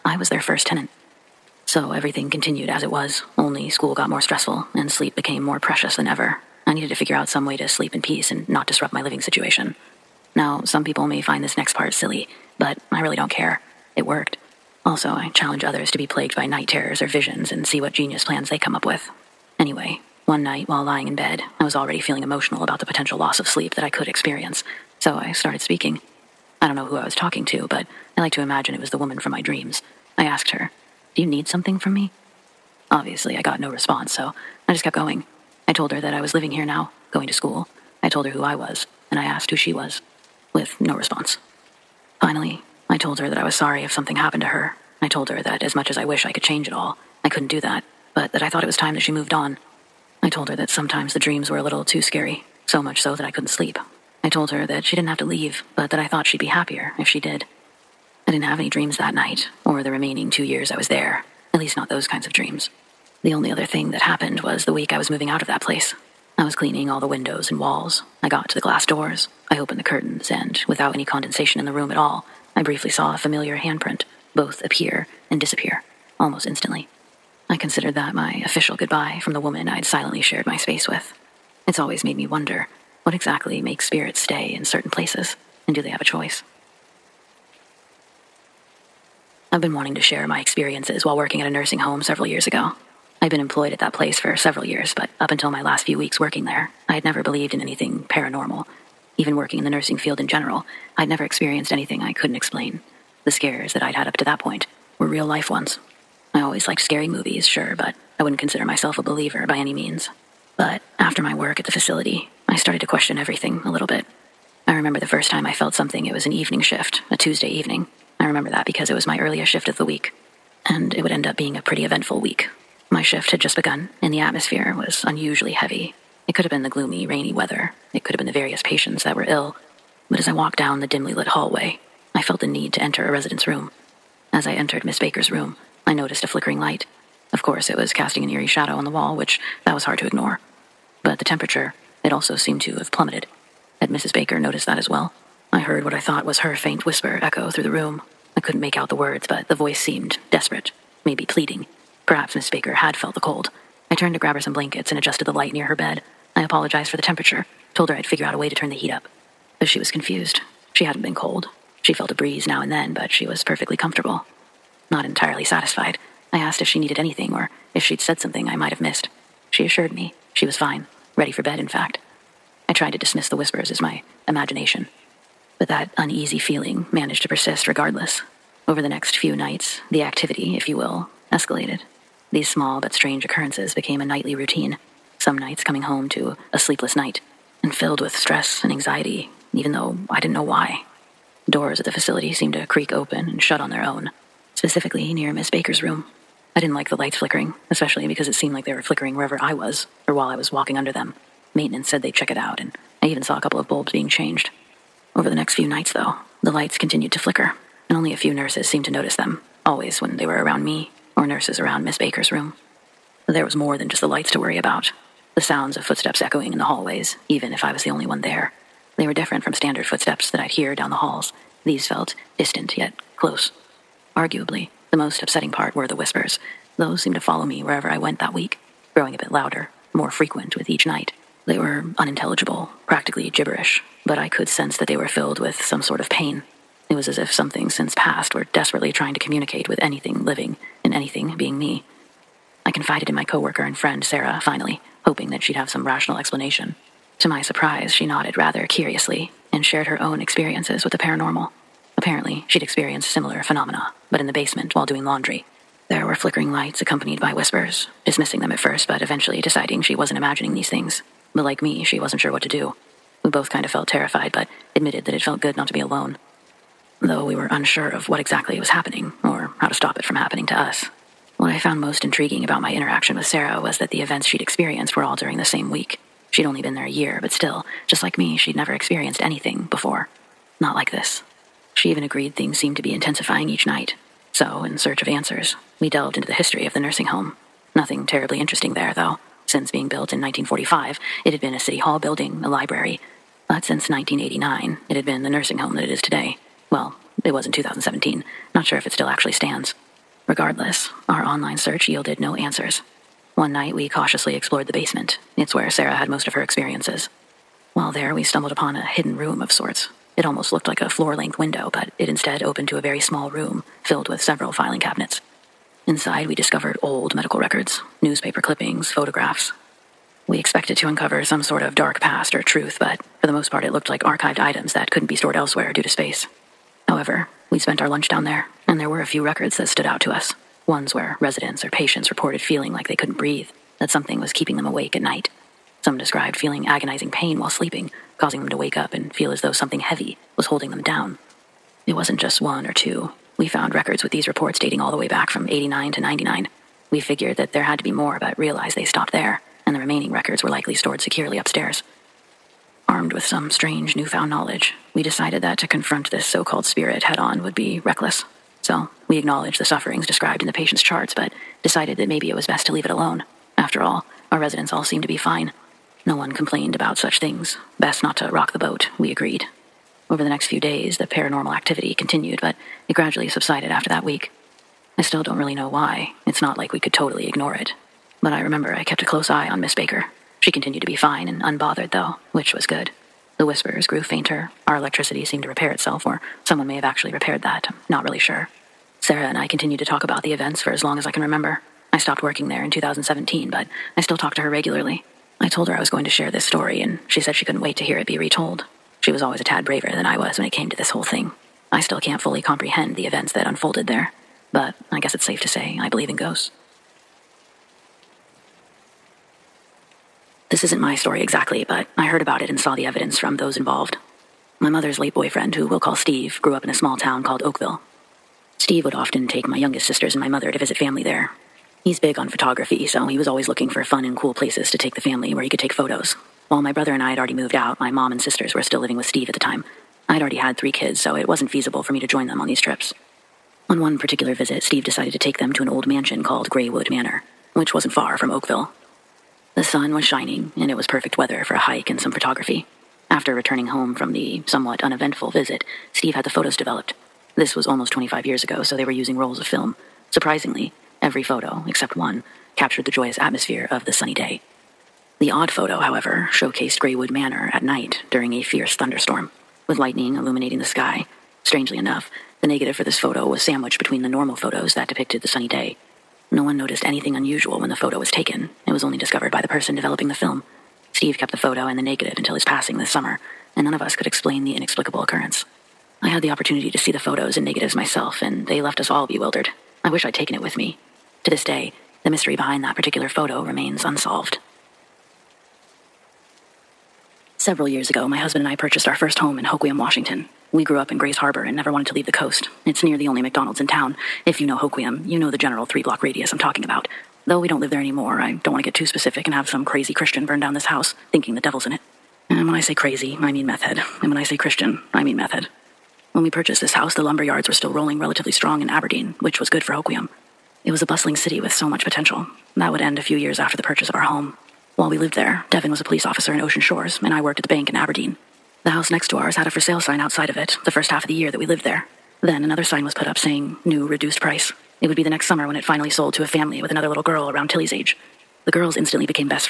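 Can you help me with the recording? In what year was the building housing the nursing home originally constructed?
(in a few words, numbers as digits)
1945.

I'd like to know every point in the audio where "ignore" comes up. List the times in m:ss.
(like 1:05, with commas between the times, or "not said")
2:20, 6:17.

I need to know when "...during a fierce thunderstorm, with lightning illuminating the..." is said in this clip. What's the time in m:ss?
7:38.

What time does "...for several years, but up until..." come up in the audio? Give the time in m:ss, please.
1:34.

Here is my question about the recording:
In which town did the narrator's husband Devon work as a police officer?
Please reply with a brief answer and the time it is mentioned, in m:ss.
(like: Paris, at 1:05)
Ocean Shores, at 8:36.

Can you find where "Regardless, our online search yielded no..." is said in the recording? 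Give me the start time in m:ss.
5:00.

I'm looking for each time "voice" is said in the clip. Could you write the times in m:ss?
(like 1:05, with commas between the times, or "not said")
2:29.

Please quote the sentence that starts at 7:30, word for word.
Surprisingly, every photo, except one, captured the joyous atmosphere of the sunny day.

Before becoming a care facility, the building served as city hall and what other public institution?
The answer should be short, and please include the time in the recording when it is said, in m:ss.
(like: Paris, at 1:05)
A library, at 4:52.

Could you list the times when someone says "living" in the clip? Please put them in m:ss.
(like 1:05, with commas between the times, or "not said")
0:09, 0:36, 4:00, 7:08.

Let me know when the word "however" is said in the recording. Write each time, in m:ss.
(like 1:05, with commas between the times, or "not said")
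5:26, 7:35.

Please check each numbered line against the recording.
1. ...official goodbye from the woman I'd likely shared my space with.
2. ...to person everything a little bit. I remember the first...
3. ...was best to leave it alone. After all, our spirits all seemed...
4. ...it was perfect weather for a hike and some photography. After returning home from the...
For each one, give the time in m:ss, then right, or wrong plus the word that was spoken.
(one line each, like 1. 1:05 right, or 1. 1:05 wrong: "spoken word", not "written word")
1. 1:18 wrong: "silently", not "likely"
2. 1:52 wrong: "question", not "person"
3. 6:02 wrong: "residents", not "spirits"
4. 7:20 right.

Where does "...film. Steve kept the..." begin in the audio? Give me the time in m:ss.
7:50.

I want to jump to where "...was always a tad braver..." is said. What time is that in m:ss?
6:39.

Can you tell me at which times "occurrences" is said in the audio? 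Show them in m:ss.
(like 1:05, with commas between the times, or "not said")
3:03, 7:55.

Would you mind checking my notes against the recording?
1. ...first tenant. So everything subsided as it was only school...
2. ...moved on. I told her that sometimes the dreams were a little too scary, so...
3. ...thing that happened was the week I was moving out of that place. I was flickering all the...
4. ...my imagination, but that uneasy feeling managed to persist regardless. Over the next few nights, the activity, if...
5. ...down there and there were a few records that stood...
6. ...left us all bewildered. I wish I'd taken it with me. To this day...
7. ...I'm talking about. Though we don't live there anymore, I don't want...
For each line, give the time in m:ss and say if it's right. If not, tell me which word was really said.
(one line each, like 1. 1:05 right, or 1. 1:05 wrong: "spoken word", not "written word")
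1. 0:00 wrong: "continued", not "subsided"
2. 0:49 right
3. 1:03 wrong: "cleaning", not "flickering"
4. 2:53 right
5. 5:28 right
6. 7:58 right
7. 8:16 right.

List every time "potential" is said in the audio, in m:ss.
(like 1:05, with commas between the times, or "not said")
0:22, 8:31.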